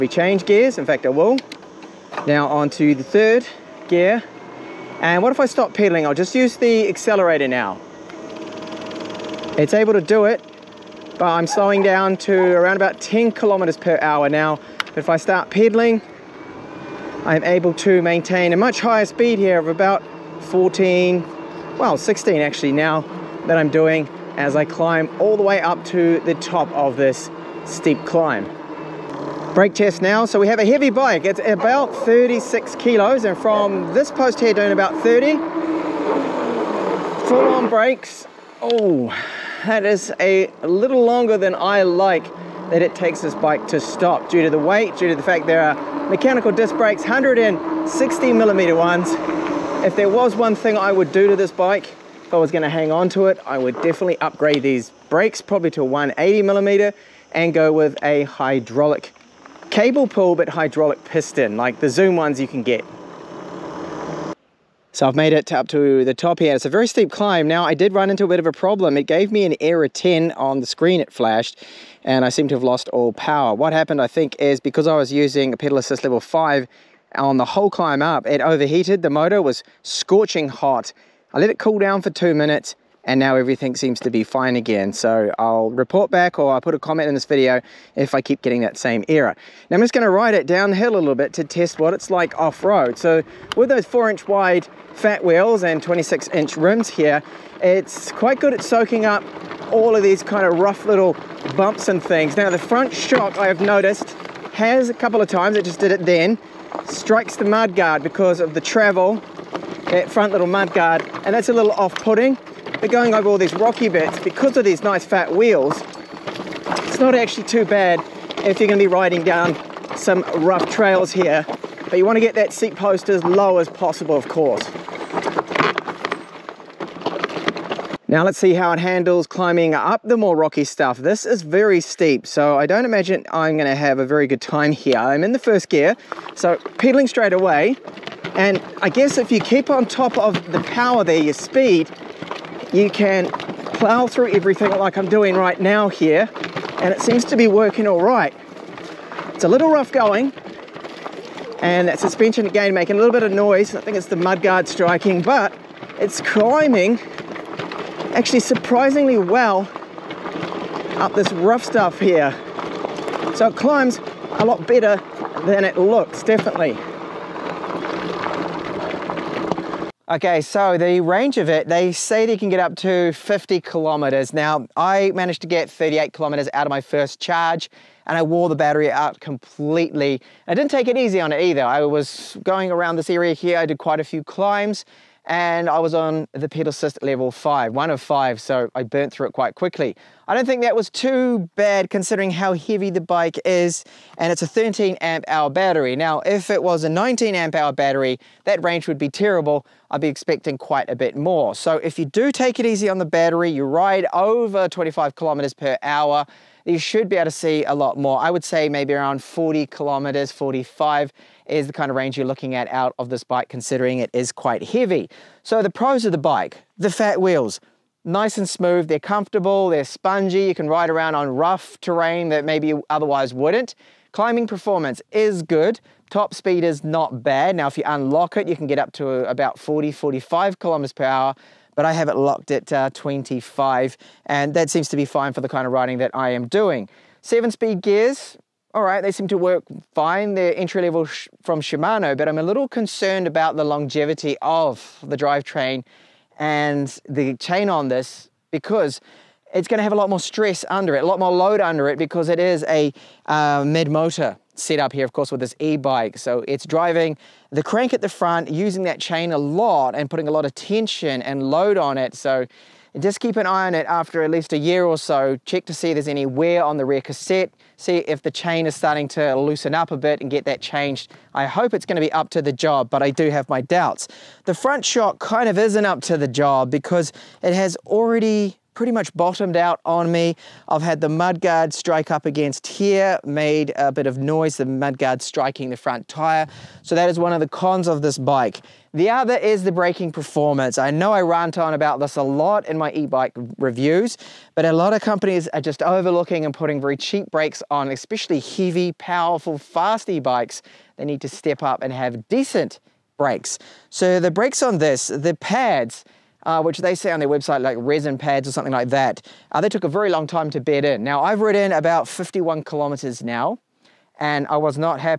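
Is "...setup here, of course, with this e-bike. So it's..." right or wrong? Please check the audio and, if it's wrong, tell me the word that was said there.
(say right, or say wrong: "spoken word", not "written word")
right.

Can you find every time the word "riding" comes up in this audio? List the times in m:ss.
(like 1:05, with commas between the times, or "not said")
1:58, 3:55.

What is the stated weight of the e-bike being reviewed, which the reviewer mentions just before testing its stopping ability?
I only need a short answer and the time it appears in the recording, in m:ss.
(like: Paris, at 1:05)
36 kilos, at 0:31.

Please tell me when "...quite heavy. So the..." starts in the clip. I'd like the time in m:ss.
3:34.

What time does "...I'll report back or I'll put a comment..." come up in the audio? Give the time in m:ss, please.
1:25.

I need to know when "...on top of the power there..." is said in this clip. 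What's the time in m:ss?
2:19.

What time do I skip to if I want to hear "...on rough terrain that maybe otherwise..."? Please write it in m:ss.
3:41.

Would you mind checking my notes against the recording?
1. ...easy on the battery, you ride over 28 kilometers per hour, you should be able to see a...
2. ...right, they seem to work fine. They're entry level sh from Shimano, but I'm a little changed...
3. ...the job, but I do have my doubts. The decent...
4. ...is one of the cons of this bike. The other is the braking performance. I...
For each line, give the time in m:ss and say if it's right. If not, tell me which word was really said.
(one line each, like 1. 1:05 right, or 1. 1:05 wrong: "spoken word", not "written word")
1. 3:22 wrong: "25", not "28"
2. 3:58 wrong: "concerned", not "changed"
3. 4:32 wrong: "front", not "decent"
4. 4:47 right.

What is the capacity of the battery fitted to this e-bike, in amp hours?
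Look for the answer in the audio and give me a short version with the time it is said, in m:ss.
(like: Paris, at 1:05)
13 amp hour, at 3:14.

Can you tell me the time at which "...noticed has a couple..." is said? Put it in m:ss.
1:43.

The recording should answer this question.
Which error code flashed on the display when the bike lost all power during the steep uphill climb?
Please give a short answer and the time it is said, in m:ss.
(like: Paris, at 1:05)
error 10, at 1:09.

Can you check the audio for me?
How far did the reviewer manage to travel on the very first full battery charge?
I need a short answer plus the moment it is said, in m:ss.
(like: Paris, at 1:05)
38 kilometers, at 2:55.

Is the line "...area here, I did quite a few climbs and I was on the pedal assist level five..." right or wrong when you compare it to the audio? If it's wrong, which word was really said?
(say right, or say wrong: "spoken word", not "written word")
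right.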